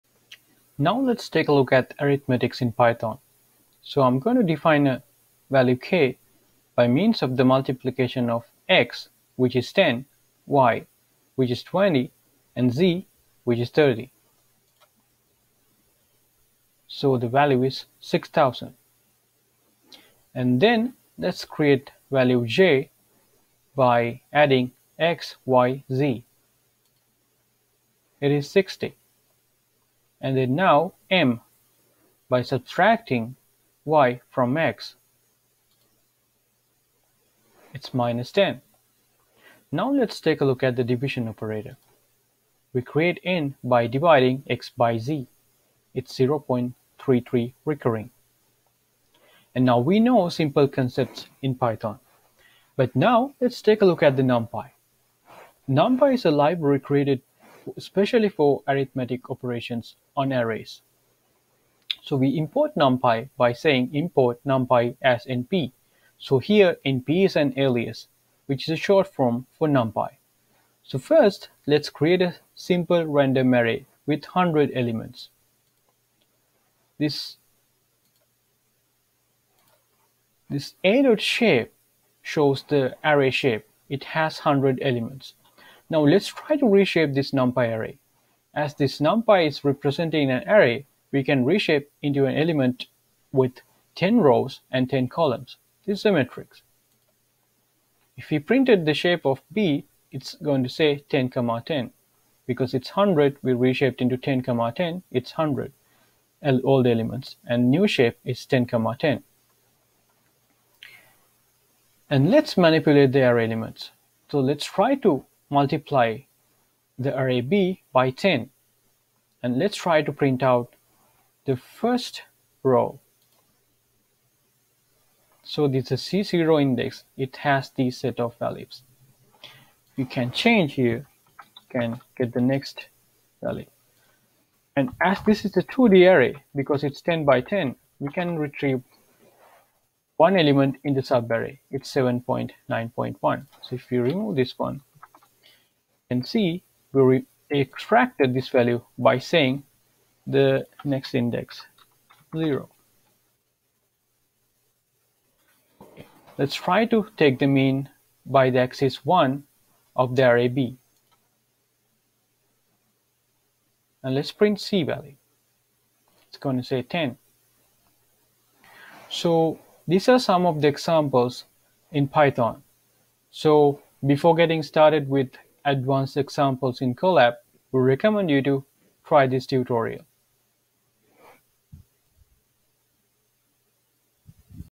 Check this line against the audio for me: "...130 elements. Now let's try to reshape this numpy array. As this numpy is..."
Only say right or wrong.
wrong.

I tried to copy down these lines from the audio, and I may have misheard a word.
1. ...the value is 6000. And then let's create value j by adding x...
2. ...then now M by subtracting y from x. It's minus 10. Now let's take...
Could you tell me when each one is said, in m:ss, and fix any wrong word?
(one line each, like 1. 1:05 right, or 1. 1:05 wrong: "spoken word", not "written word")
1. 0:17 right
2. 0:30 right.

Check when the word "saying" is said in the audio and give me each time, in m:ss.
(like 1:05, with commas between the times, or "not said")
1:03, 2:29.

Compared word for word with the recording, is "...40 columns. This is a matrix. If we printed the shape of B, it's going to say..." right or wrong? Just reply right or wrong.
wrong.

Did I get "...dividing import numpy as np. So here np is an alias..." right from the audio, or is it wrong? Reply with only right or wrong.
wrong.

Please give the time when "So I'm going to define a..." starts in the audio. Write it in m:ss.
0:03.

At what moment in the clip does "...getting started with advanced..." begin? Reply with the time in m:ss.
2:54.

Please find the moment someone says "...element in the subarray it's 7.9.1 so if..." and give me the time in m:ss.
2:20.